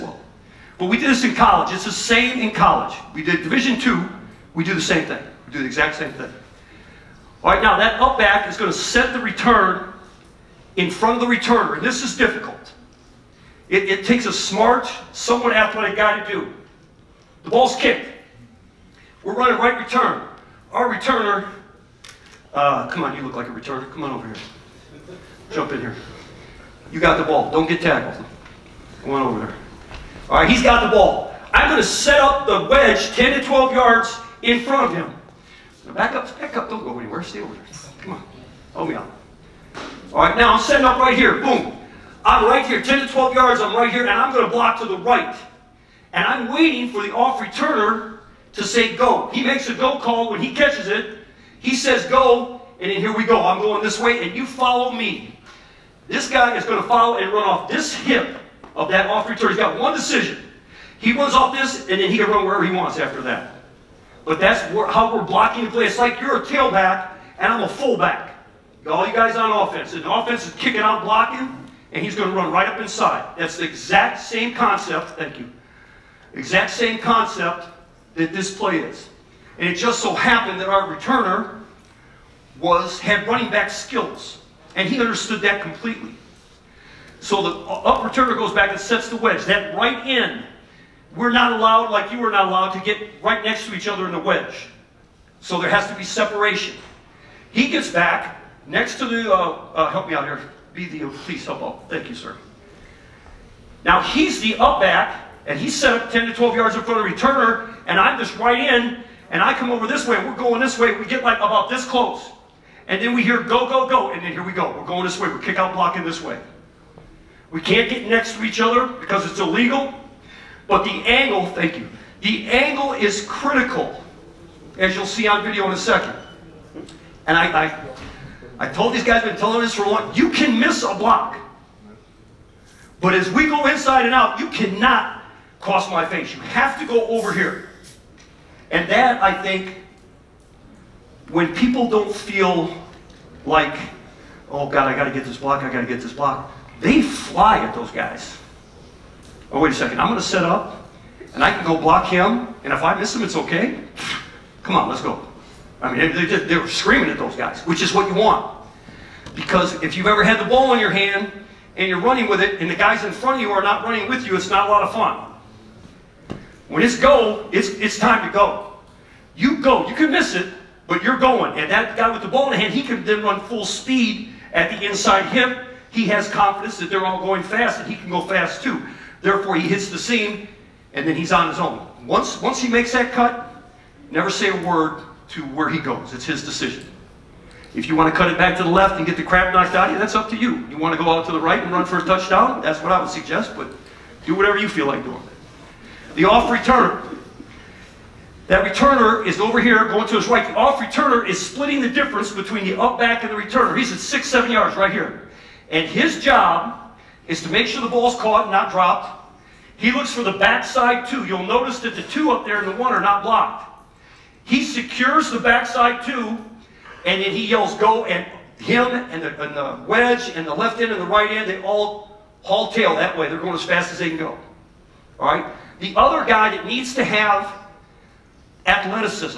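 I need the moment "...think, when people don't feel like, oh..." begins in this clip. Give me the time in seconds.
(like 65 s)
139 s.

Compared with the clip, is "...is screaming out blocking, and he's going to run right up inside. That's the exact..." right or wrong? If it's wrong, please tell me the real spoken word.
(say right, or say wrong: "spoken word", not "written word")
wrong: "kicking", not "screaming".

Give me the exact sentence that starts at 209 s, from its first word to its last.
He looks for the backside two.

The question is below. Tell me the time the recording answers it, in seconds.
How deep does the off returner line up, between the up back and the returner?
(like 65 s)
203 s.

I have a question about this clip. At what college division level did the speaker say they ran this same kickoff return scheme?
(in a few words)
Division 2.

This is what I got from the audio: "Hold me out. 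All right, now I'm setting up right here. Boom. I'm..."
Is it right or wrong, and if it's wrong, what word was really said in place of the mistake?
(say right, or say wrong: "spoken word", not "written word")
right.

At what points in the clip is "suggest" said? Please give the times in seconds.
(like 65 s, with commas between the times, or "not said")
193 s.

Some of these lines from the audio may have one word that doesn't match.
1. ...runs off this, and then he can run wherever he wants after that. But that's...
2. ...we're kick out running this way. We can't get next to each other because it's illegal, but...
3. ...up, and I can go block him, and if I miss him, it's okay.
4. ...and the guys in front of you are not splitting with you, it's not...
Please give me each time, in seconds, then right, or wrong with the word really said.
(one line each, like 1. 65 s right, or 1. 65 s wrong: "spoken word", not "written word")
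1. 61 s right
2. 115 s wrong: "blocking", not "running"
3. 150 s right
4. 162 s wrong: "running", not "splitting".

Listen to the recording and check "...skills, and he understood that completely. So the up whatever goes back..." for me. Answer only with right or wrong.
wrong.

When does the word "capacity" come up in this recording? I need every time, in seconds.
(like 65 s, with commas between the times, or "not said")
not said.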